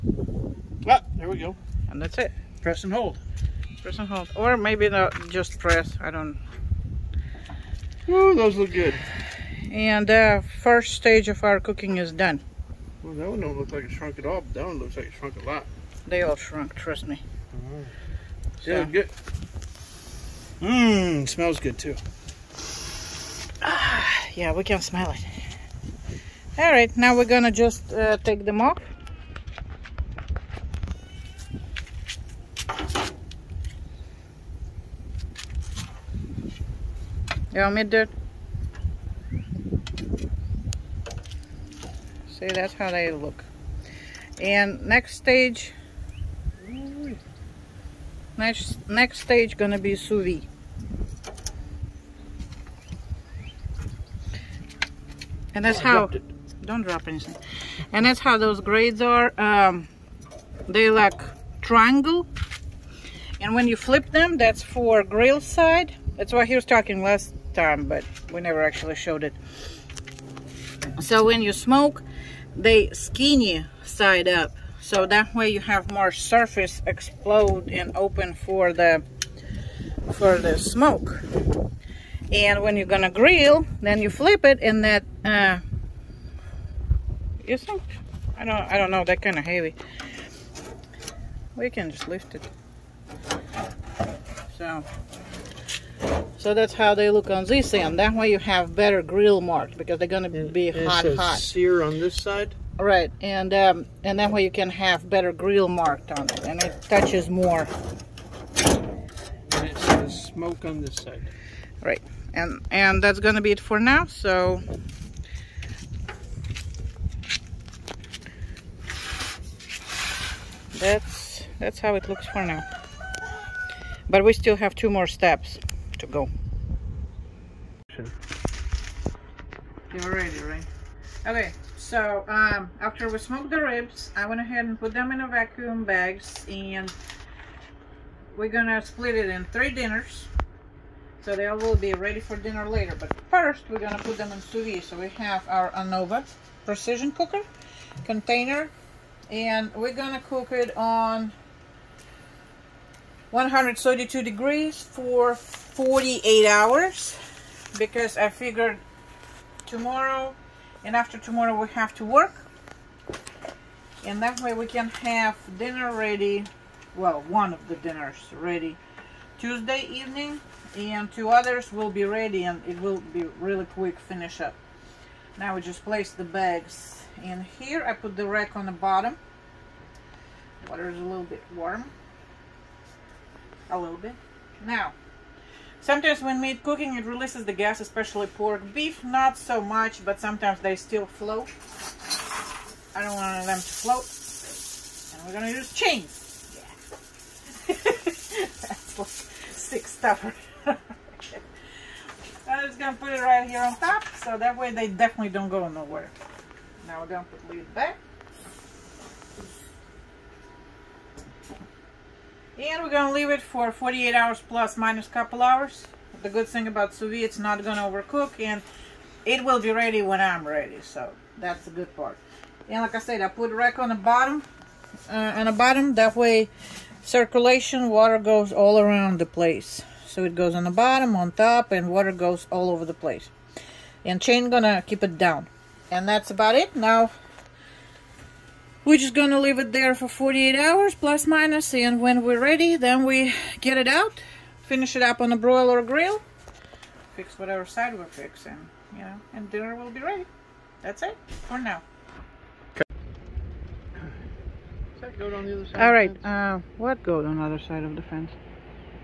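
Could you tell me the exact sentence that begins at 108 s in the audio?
And it says smoke on this side.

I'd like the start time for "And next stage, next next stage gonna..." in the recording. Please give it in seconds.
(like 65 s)
44 s.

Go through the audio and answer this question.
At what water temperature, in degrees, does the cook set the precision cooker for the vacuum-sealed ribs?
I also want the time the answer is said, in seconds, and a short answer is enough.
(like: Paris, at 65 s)
132, at 153 s.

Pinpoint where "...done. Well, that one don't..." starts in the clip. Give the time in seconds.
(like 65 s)
12 s.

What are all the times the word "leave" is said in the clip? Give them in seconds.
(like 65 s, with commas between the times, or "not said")
213 s, 239 s.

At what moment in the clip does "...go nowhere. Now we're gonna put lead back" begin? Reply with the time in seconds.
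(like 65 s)
205 s.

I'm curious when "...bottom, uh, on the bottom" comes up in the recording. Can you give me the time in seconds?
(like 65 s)
223 s.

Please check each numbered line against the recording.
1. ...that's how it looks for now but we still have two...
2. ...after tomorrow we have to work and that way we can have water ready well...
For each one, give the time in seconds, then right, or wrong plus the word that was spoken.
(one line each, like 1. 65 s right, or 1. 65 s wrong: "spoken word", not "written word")
1. 121 s right
2. 160 s wrong: "dinner", not "water".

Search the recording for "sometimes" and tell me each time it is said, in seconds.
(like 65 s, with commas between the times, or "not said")
185 s, 190 s.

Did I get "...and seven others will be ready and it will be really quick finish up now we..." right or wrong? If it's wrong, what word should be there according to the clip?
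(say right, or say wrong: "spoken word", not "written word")
wrong: "two", not "seven".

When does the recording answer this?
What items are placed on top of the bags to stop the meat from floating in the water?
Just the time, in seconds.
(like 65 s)
195 s.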